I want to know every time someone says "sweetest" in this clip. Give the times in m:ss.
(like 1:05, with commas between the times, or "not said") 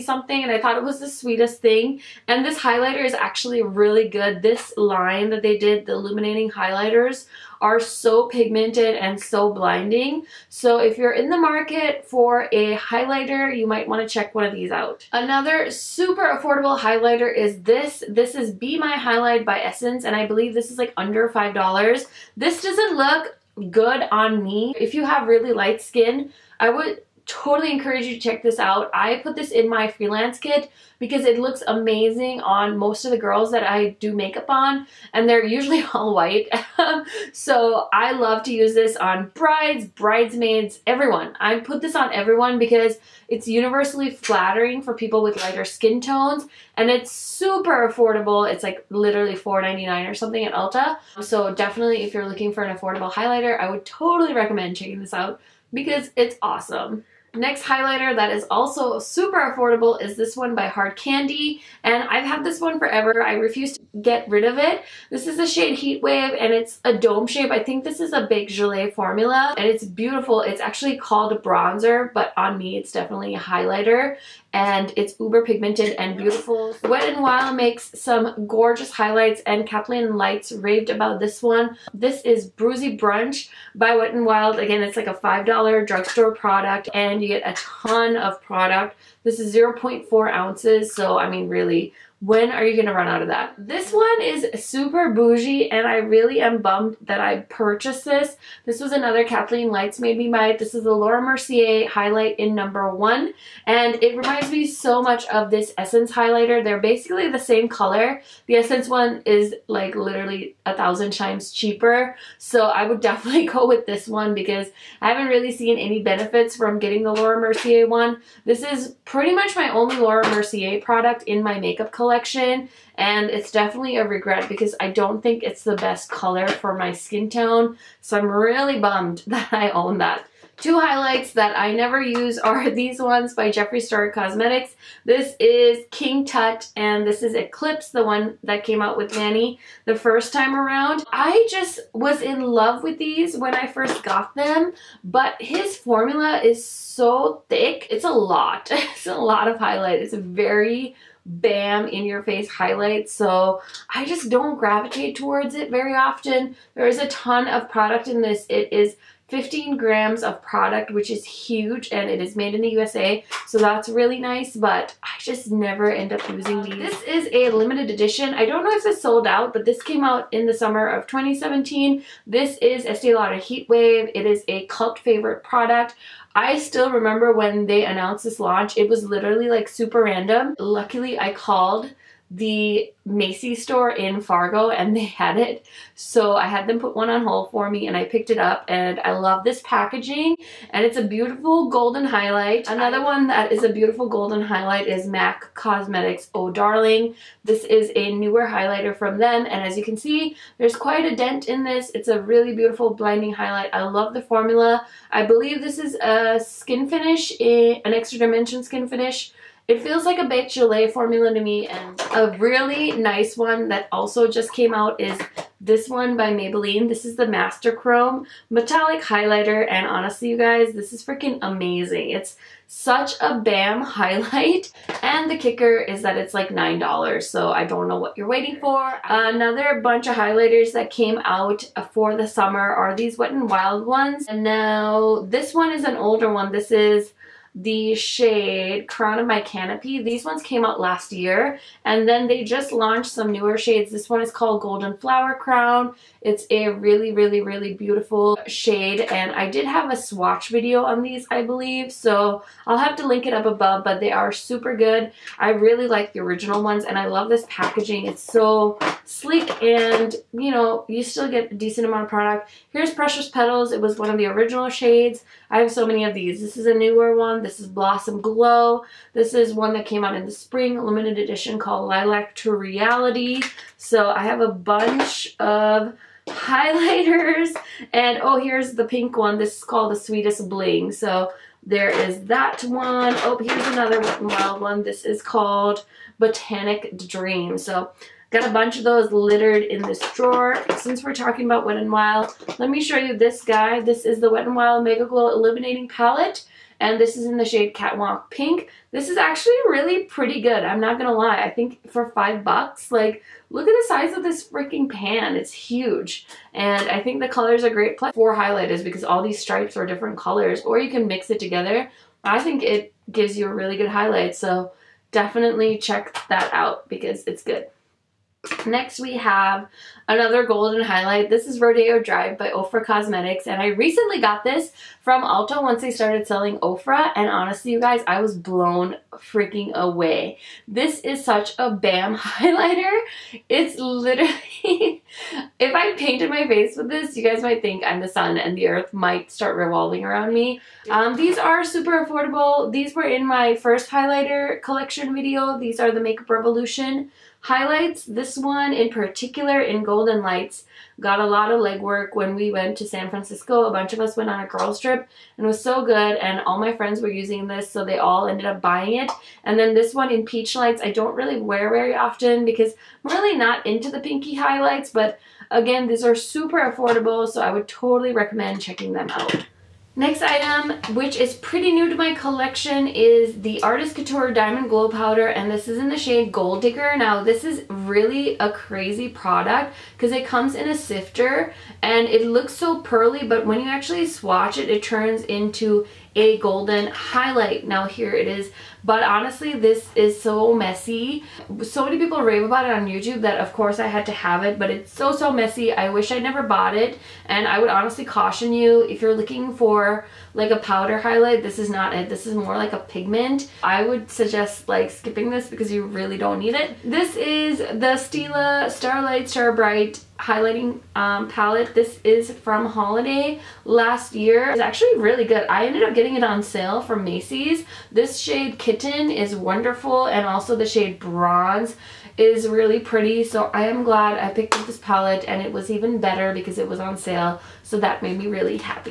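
0:01, 4:39.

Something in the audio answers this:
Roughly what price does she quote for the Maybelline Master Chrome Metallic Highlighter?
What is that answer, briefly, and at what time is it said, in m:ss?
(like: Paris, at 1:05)
$9, at 3:46.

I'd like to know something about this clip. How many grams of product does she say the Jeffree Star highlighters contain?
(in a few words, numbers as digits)
15 grams.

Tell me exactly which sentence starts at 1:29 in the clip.
This is 0.4 ounces, so I mean really when are you going to run out of that?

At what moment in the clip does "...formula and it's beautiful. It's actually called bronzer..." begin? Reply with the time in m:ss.
1:08.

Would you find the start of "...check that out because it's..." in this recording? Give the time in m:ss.
5:15.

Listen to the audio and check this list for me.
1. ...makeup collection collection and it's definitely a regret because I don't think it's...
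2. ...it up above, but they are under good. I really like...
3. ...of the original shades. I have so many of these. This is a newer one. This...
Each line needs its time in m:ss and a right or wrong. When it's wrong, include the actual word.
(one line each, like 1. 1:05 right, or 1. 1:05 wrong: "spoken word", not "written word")
1. 2:01 right
2. 4:13 wrong: "super", not "under"
3. 4:24 right.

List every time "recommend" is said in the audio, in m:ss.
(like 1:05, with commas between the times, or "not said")
0:54, 6:08.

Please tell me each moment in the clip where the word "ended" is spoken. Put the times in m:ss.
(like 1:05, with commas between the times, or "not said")
5:58, 6:55.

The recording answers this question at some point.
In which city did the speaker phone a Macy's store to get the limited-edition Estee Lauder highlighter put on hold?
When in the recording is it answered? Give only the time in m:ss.
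3:04.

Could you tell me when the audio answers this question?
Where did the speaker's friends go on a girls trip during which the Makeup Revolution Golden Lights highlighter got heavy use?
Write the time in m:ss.
5:52.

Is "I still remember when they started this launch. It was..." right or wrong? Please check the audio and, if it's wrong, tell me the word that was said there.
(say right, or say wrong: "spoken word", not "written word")
wrong: "announced", not "started".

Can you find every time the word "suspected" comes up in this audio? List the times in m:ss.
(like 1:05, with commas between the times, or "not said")
not said.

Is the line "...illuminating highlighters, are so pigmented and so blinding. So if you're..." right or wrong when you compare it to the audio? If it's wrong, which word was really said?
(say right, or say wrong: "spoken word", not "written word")
right.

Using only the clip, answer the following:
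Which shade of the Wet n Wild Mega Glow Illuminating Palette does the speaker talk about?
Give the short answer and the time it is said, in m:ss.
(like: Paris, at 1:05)
Catwalk Pink, at 4:57.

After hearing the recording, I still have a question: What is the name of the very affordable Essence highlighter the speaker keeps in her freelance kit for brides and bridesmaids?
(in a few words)
Be My Highlight.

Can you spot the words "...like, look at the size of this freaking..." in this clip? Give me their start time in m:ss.
5:02.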